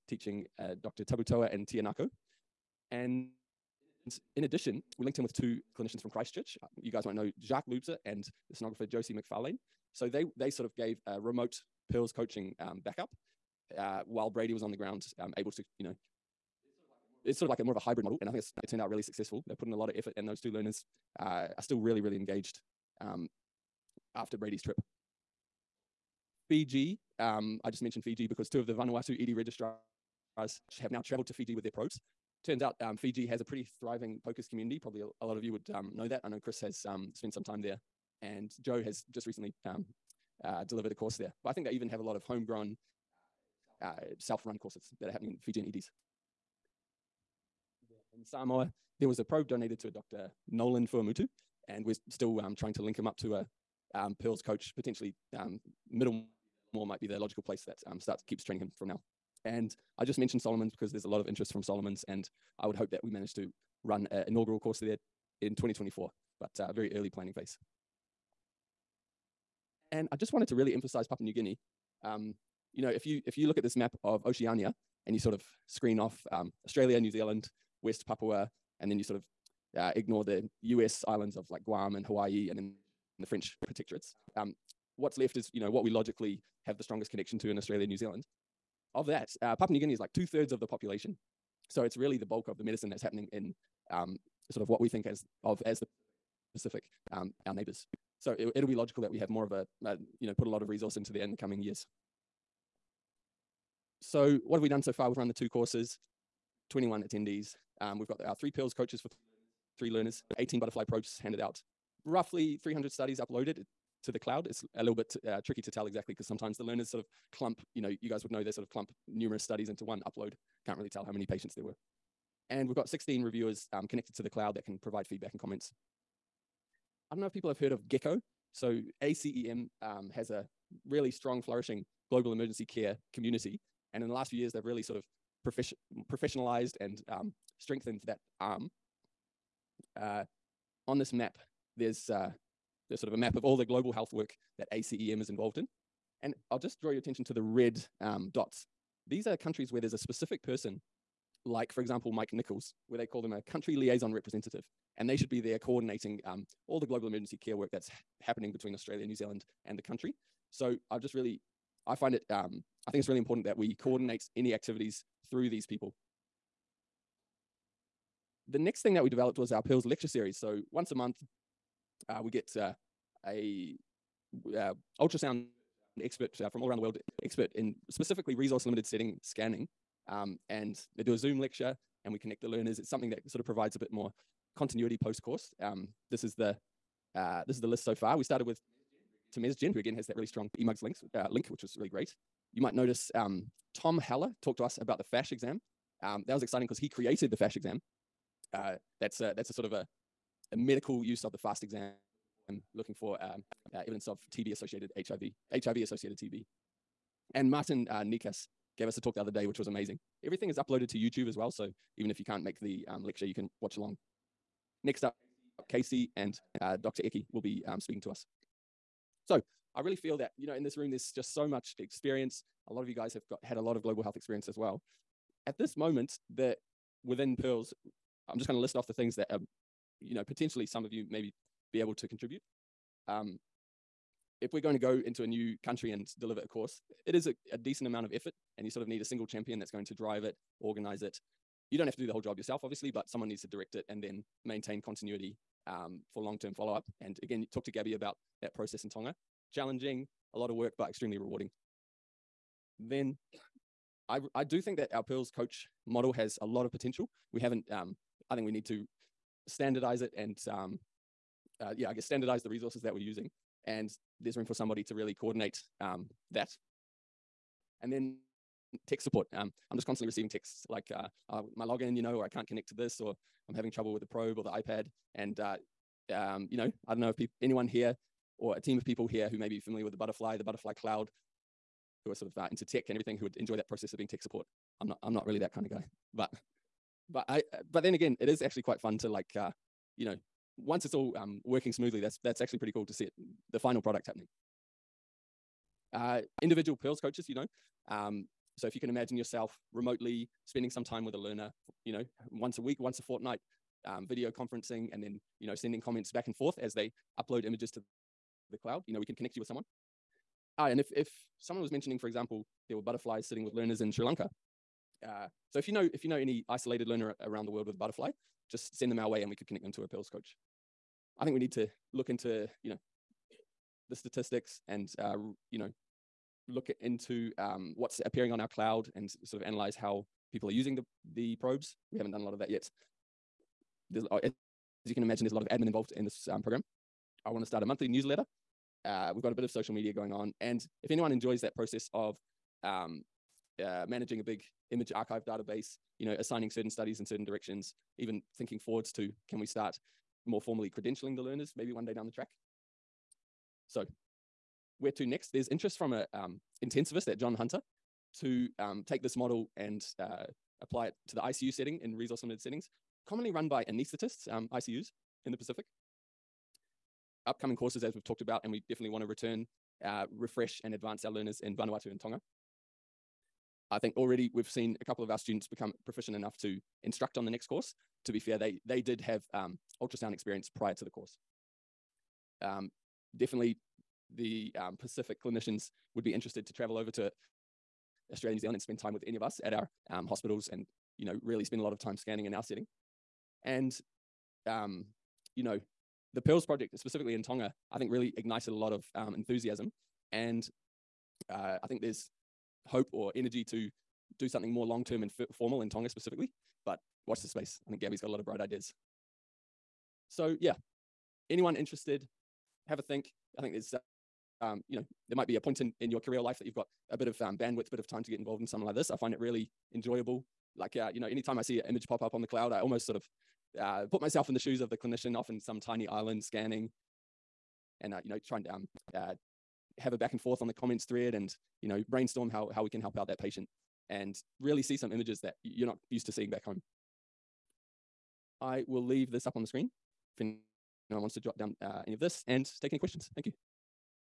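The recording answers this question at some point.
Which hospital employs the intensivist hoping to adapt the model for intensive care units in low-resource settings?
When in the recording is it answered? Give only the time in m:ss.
5:57.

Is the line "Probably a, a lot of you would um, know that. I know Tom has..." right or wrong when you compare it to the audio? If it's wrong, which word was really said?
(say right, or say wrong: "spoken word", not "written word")
wrong: "Chris", not "Tom".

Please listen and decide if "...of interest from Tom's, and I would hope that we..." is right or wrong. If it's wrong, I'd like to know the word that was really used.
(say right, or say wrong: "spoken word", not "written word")
wrong: "Solomon", not "Tom".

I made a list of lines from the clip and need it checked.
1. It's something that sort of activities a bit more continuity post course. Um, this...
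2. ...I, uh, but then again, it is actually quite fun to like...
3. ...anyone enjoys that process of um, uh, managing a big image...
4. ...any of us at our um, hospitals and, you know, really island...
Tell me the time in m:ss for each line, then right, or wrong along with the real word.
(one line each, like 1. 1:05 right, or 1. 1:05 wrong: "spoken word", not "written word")
1. 3:02 wrong: "provides", not "activities"
2. 4:47 right
3. 5:40 right
4. 6:29 wrong: "spend", not "island".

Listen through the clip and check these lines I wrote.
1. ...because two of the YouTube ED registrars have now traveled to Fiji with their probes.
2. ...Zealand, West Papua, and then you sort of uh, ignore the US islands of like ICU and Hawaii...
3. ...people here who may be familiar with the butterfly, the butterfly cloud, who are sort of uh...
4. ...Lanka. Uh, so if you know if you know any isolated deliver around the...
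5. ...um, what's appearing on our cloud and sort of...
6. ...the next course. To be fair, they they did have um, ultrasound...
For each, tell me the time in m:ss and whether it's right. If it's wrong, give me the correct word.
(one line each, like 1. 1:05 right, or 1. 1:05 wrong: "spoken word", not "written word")
1. 0:28 wrong: "Vanuatu", not "YouTube"
2. 1:17 wrong: "Guam", not "ICU"
3. 4:38 right
4. 5:14 wrong: "learner", not "deliver"
5. 5:27 right
6. 6:17 right.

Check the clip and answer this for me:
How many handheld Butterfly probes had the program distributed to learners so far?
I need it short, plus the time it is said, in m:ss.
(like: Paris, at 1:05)
18, at 1:50.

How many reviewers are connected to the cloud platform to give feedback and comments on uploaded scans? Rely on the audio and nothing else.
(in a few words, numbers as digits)
16.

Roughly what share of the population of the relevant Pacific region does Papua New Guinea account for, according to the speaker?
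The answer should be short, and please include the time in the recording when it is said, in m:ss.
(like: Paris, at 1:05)
two thirds, at 1:30.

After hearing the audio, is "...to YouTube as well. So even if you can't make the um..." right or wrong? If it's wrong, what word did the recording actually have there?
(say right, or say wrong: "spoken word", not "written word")
right.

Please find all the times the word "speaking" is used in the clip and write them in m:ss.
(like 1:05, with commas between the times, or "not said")
3:37.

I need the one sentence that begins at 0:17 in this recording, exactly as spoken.
It's sort of like a more of a hybrid model, and I think it's, it turned out really successful.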